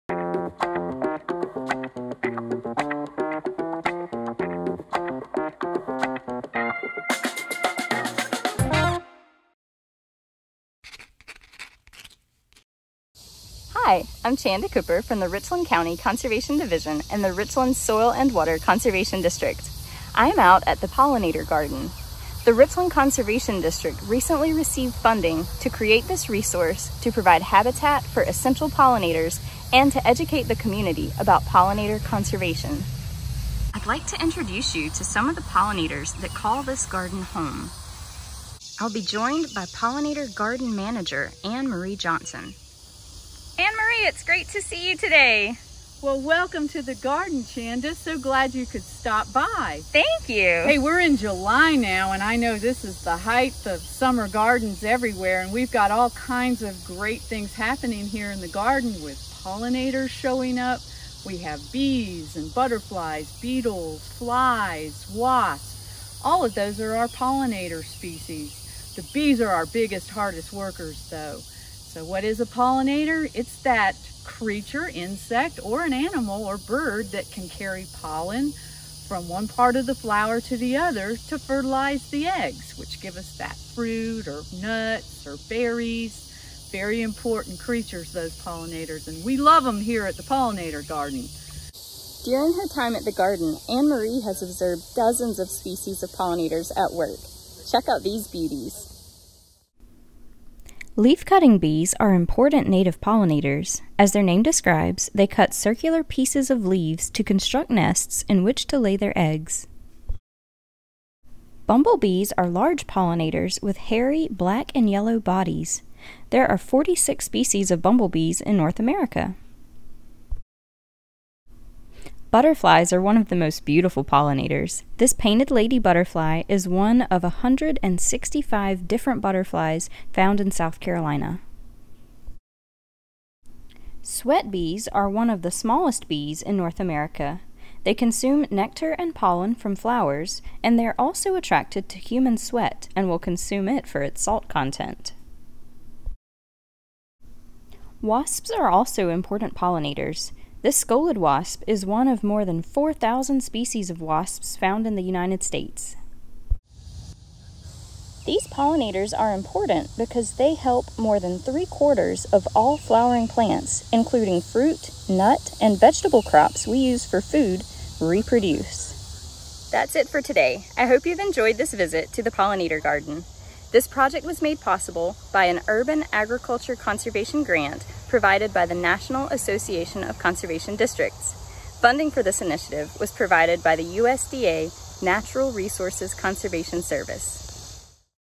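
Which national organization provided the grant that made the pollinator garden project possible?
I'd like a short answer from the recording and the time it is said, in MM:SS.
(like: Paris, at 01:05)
National Association of Conservation Districts, at 02:58.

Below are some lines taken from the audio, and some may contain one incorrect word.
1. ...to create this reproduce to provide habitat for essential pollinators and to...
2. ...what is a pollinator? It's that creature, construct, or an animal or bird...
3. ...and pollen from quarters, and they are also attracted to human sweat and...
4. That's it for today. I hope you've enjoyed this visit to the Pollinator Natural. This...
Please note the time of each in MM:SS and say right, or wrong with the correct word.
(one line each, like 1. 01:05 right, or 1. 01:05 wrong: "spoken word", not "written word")
1. 00:25 wrong: "resource", not "reproduce"
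2. 01:12 wrong: "insect", not "construct"
3. 02:18 wrong: "flowers", not "quarters"
4. 02:49 wrong: "Garden", not "Natural".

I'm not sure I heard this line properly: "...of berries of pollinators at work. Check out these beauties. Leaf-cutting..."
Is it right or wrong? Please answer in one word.
wrong.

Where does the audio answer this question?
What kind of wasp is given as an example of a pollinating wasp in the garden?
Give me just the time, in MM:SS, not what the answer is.
02:30.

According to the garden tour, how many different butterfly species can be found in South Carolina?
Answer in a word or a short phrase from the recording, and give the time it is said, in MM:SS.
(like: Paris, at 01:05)
165, at 02:07.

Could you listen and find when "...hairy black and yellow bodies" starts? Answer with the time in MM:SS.
01:53.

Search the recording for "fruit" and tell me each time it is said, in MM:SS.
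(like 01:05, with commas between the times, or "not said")
01:23, 02:44.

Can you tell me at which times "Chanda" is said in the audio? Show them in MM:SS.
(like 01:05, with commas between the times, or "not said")
00:14, 00:47.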